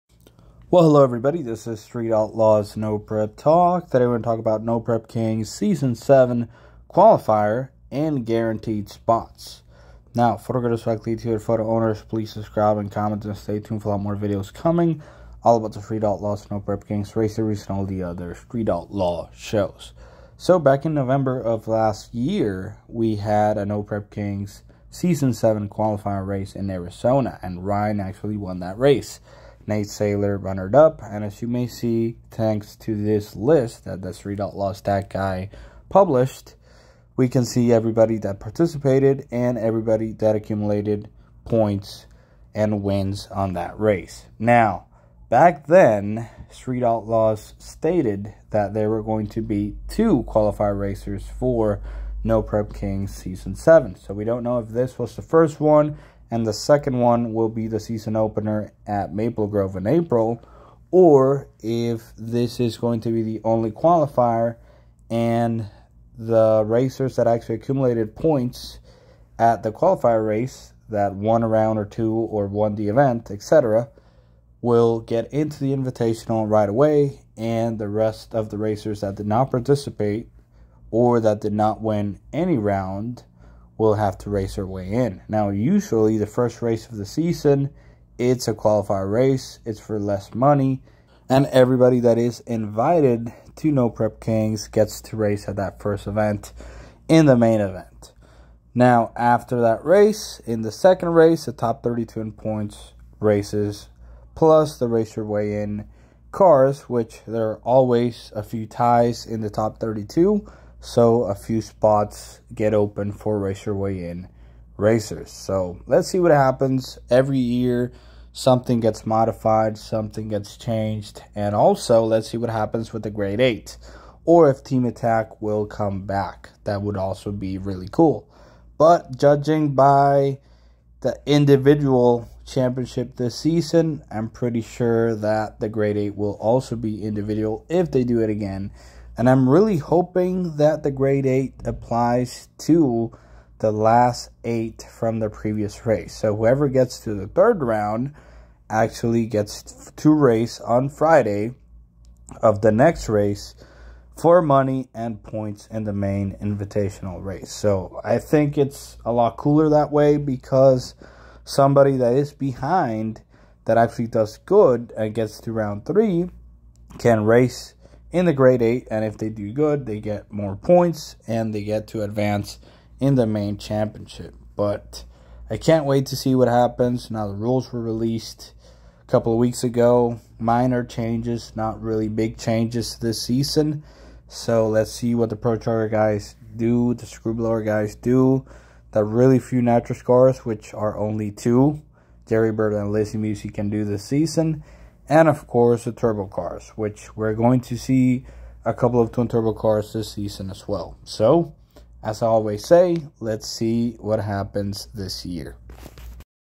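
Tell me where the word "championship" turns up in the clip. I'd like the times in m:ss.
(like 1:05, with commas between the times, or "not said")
2:12, 2:53.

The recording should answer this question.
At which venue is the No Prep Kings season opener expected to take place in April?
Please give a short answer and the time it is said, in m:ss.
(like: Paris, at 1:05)
Maple Grove, at 0:59.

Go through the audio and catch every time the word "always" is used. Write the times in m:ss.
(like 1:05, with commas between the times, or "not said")
1:47, 3:22.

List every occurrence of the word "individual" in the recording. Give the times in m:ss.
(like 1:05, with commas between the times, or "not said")
2:11, 2:17.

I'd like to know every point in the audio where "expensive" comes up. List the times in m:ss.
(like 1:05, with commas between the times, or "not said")
not said.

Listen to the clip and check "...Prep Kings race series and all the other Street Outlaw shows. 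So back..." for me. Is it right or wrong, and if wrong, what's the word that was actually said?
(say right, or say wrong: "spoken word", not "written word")
right.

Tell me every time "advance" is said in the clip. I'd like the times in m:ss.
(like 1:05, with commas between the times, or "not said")
2:52.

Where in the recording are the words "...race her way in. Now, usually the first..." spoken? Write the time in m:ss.
1:24.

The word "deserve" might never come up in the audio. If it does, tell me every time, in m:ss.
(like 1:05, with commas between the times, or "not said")
not said.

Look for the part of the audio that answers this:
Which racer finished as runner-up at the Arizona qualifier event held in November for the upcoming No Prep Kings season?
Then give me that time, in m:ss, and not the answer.
0:29.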